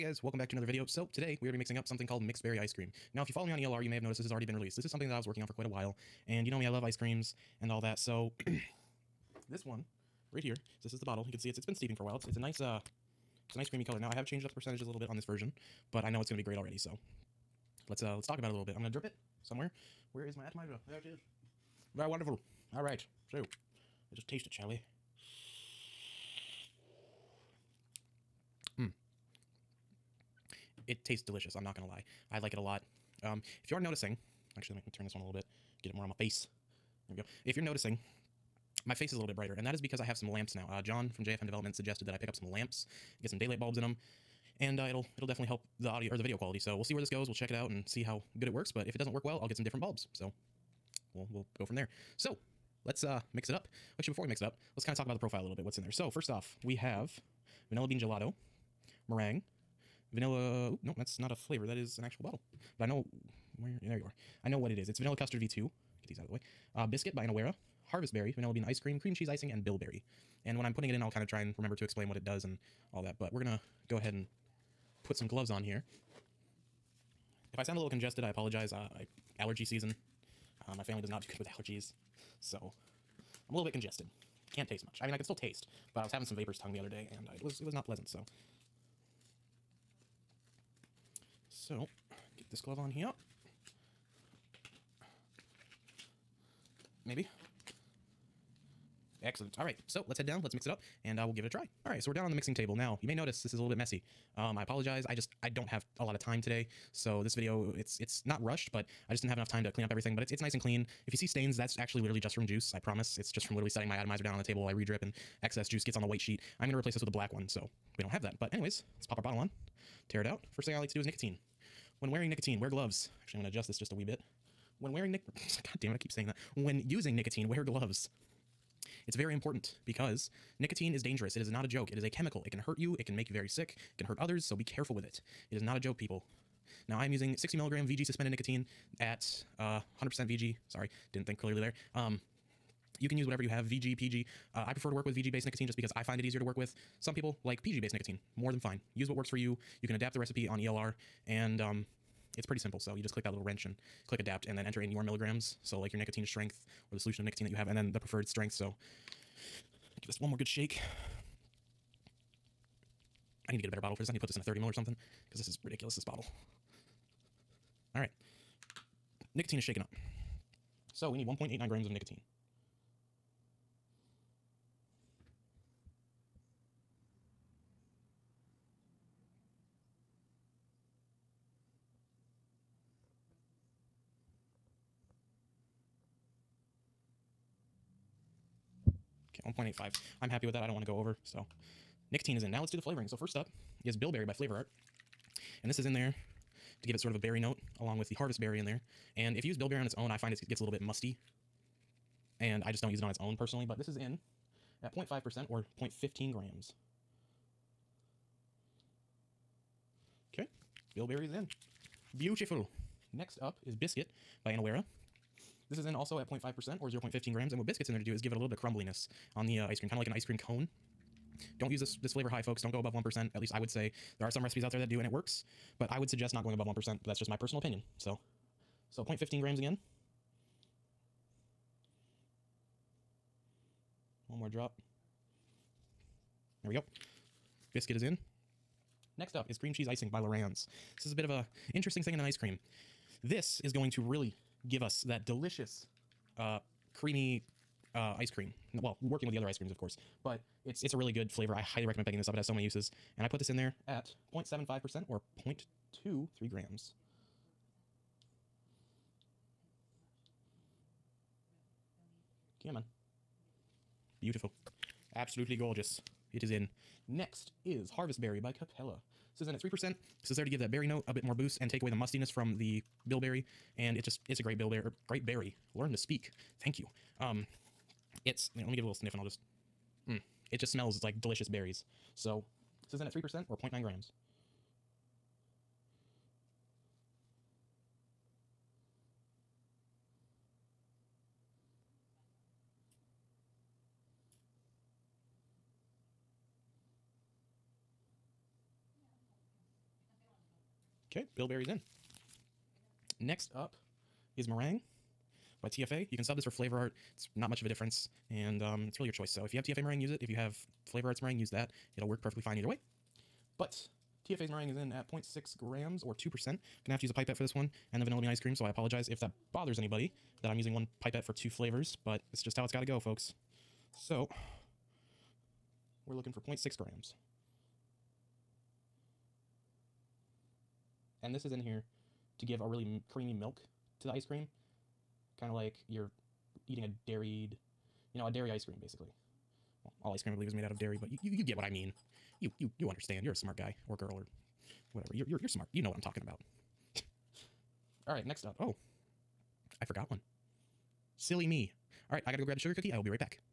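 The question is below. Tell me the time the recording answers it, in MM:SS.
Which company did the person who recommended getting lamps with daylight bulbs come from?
00:41.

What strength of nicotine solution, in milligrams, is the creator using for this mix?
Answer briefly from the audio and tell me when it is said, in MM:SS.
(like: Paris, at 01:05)
60 milligram, at 02:17.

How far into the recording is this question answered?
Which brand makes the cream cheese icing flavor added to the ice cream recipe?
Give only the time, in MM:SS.
04:00.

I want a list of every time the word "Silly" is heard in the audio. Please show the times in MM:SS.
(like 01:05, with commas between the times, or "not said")
05:51.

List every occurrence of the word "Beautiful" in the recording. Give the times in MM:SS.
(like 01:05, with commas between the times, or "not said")
03:32, 04:24.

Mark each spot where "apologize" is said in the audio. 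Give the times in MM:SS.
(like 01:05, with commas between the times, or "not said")
01:18, 01:44, 05:18.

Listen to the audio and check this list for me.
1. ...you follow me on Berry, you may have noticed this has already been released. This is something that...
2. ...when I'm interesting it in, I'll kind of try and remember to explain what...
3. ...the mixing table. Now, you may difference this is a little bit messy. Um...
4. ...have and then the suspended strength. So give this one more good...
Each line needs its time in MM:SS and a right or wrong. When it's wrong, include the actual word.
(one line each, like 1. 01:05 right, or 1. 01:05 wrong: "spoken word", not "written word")
1. 00:03 wrong: "ELR", not "Berry"
2. 01:10 wrong: "putting", not "interesting"
3. 01:42 wrong: "notice", not "difference"
4. 02:37 wrong: "preferred", not "suspended".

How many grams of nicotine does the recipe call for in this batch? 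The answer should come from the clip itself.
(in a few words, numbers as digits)
1.89 grams.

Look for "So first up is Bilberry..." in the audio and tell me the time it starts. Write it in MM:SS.
03:13.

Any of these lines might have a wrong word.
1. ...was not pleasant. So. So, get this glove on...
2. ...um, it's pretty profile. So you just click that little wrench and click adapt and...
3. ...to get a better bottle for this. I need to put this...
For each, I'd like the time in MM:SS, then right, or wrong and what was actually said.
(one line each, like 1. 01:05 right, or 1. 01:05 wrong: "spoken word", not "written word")
1. 01:27 right
2. 02:31 wrong: "simple", not "profile"
3. 02:43 right.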